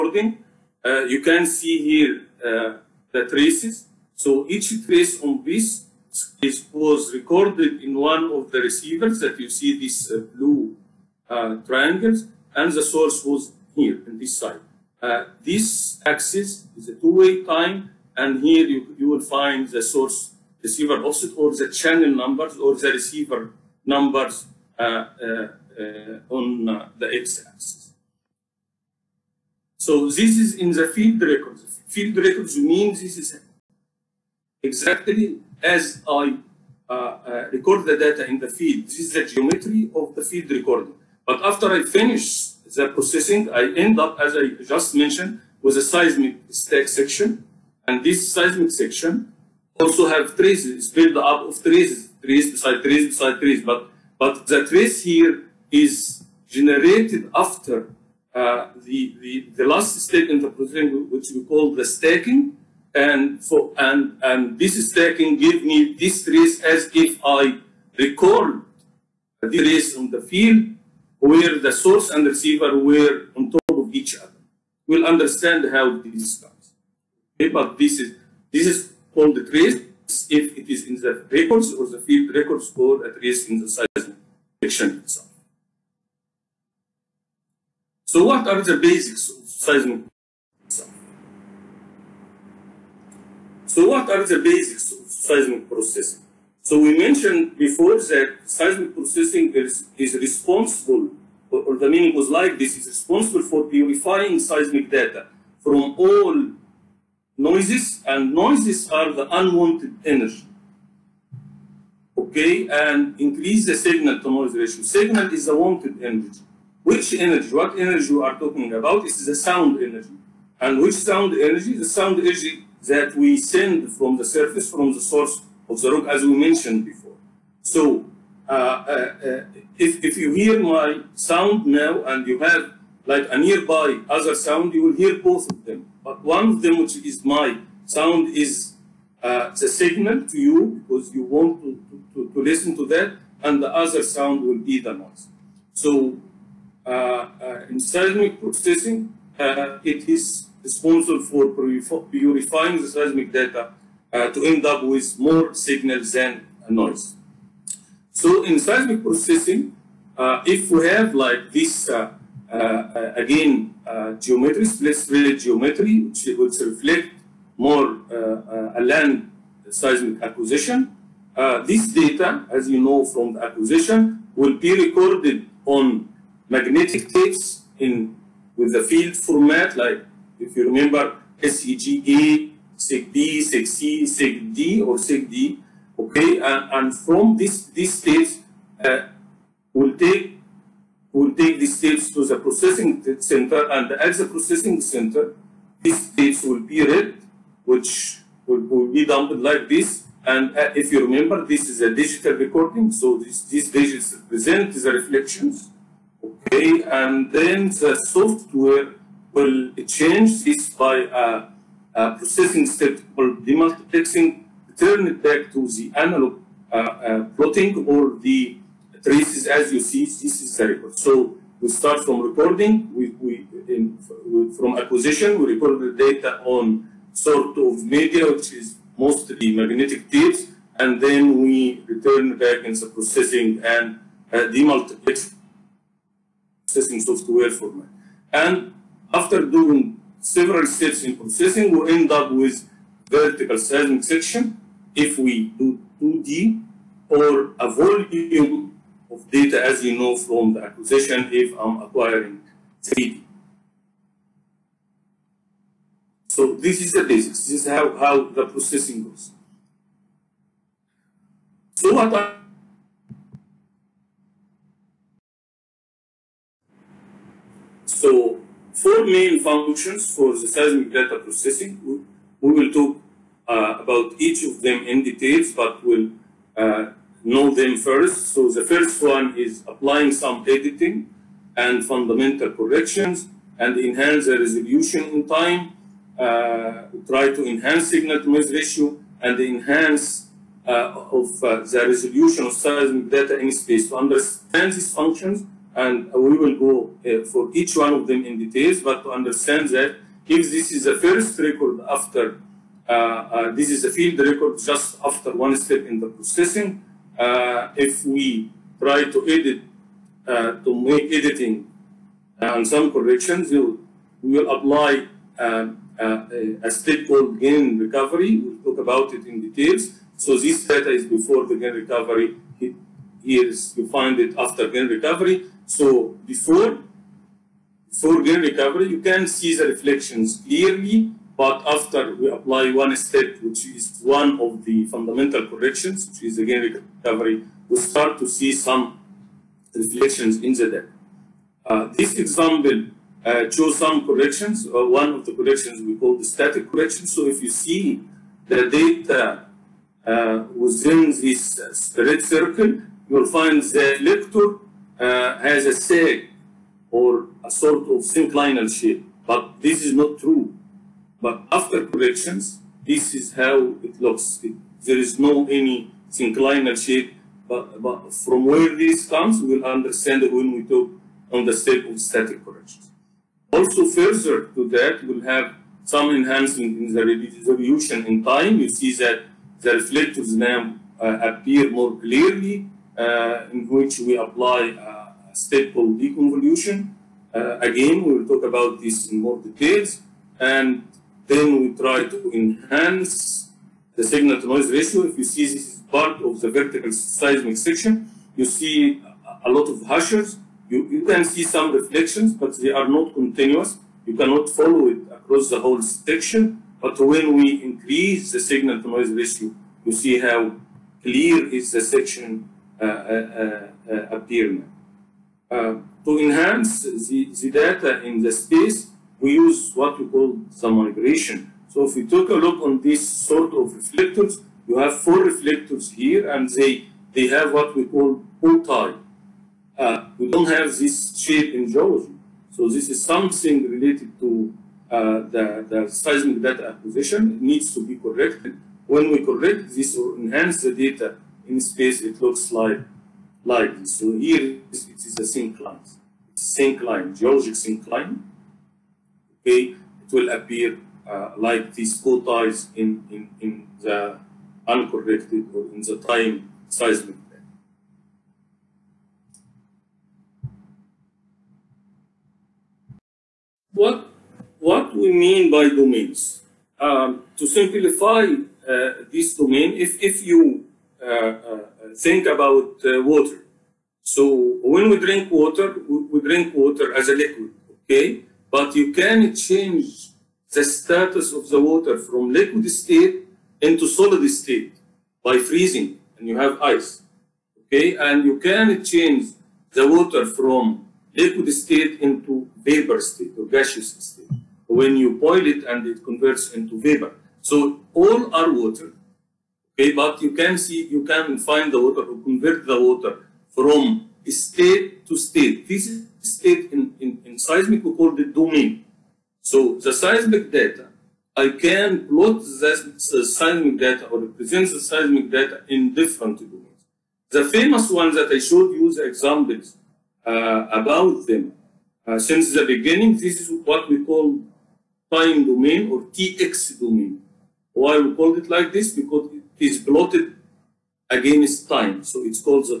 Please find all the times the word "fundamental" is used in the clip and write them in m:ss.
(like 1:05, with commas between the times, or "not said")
4:41, 5:34.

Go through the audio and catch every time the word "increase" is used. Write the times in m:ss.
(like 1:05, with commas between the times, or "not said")
1:53, 6:47.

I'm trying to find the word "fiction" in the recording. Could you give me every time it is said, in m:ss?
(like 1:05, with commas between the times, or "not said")
not said.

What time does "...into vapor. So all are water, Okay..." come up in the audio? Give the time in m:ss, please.
8:16.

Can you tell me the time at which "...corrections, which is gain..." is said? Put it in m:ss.
5:35.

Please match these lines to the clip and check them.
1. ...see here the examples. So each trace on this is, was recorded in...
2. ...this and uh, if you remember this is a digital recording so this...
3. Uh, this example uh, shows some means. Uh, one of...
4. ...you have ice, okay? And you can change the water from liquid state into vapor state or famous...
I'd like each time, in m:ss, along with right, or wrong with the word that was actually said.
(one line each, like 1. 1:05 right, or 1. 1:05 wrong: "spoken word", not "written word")
1. 0:01 wrong: "traces", not "examples"
2. 3:19 right
3. 5:41 wrong: "corrections", not "means"
4. 8:06 wrong: "gaseous", not "famous".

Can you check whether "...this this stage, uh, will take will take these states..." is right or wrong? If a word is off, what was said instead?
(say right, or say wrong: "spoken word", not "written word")
right.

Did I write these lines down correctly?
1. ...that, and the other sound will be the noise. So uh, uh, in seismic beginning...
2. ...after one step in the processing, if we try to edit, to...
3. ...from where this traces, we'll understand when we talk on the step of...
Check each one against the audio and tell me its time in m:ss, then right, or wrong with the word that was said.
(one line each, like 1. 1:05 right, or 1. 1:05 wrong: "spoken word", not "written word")
1. 2:22 wrong: "processing", not "beginning"
2. 5:05 right
3. 6:08 wrong: "comes", not "traces".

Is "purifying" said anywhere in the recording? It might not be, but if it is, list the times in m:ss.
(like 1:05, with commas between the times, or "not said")
1:43, 2:32.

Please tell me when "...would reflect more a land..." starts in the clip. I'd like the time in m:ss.
2:46.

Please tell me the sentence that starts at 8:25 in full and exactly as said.
This is state in, in, in seismic, we call the domain.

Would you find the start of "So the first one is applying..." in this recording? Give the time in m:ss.
4:38.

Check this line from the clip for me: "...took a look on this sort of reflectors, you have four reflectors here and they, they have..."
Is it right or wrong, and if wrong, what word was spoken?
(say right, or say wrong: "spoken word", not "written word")
right.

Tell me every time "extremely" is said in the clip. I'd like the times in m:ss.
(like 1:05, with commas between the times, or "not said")
not said.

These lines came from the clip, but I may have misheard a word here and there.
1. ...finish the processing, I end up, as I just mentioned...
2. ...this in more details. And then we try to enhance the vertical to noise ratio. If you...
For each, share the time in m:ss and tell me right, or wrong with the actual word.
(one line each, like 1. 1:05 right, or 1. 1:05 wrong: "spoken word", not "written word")
1. 0:41 right
2. 6:28 wrong: "signal", not "vertical".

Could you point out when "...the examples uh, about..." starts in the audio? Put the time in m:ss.
8:38.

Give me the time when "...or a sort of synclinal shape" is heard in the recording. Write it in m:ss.
5:56.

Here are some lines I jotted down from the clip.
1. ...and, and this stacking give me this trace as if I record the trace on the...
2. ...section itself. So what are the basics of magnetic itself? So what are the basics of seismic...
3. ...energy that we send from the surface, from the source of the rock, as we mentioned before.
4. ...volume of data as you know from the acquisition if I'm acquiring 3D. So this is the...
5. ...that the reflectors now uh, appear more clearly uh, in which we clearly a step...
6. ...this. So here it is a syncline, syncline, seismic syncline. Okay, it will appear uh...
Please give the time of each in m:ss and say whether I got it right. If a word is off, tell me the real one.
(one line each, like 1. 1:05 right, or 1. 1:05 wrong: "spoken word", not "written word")
1. 1:03 right
2. 1:24 wrong: "seismic", not "magnetic"
3. 2:02 right
4. 4:07 right
5. 6:18 wrong: "apply", not "clearly"
6. 7:23 wrong: "geologic", not "seismic".